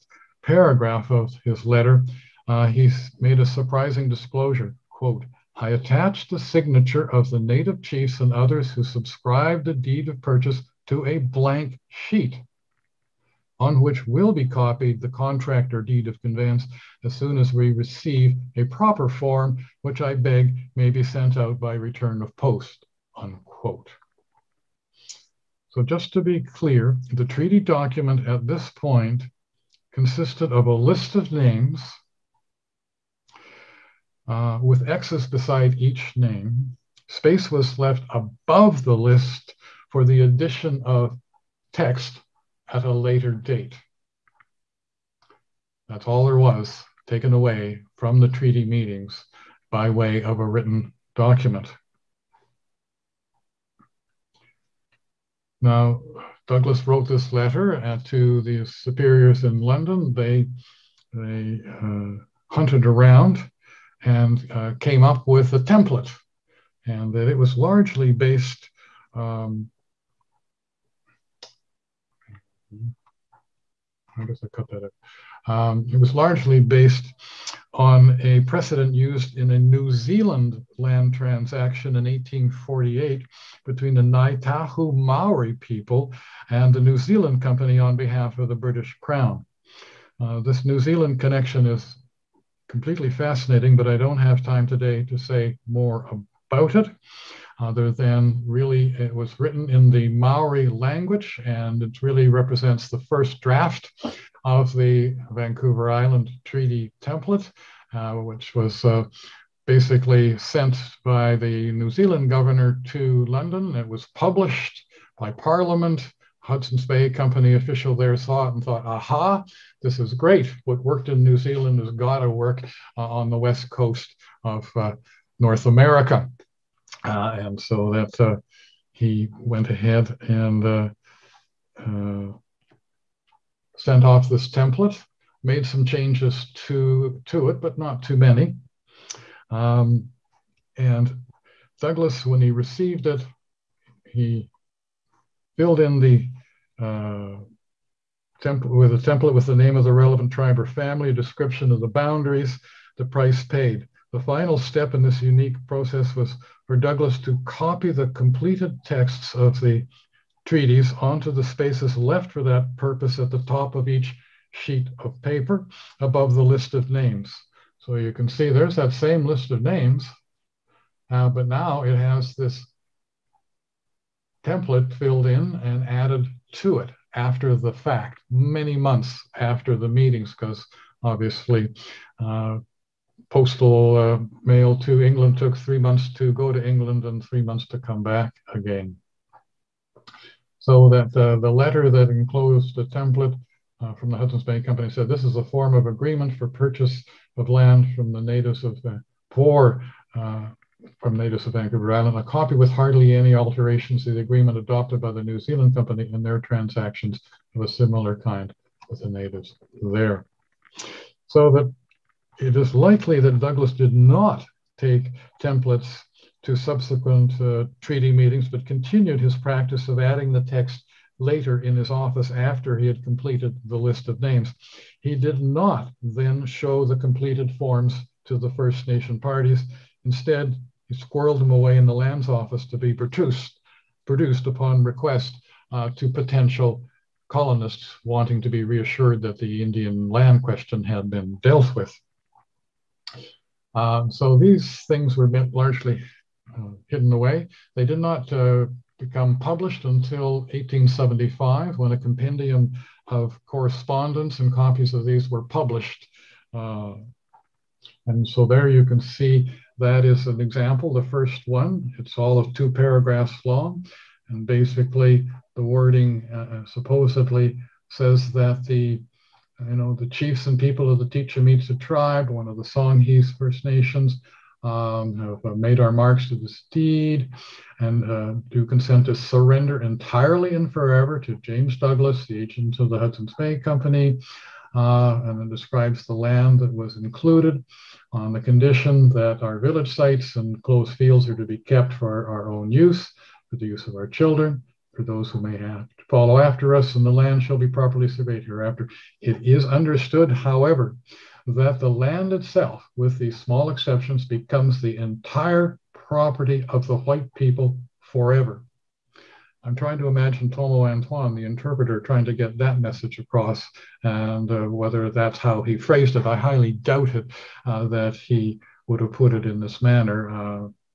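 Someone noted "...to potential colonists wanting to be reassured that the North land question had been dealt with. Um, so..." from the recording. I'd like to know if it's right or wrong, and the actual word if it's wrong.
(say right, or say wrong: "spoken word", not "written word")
wrong: "Indian", not "North".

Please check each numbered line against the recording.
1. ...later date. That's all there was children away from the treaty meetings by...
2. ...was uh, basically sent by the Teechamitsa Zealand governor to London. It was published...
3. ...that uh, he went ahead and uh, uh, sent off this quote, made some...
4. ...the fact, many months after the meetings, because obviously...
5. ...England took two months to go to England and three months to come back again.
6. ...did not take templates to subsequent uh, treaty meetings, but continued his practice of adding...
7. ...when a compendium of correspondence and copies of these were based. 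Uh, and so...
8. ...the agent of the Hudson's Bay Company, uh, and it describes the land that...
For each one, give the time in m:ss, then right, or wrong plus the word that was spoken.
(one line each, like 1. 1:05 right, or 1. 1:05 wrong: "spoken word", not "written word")
1. 0:42 wrong: "taken", not "children"
2. 1:48 wrong: "New", not "Teechamitsa"
3. 2:07 wrong: "template", not "quote"
4. 2:57 right
5. 3:05 wrong: "three", not "two"
6. 3:33 right
7. 4:11 wrong: "published", not "based"
8. 4:42 right.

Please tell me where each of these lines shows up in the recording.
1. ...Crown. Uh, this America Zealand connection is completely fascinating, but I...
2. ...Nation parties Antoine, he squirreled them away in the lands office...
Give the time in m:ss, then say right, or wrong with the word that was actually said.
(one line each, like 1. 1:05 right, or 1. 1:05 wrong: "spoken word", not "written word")
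1. 1:29 wrong: "New", not "America"
2. 3:48 wrong: "Instead", not "Antoine".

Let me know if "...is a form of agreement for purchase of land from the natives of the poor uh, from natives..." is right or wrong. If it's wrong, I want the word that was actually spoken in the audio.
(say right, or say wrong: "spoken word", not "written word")
right.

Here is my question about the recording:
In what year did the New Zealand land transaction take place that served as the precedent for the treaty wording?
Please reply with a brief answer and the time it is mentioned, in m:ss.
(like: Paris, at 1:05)
1848, at 1:22.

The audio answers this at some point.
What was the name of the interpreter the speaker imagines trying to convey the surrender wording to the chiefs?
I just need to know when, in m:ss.
5:10.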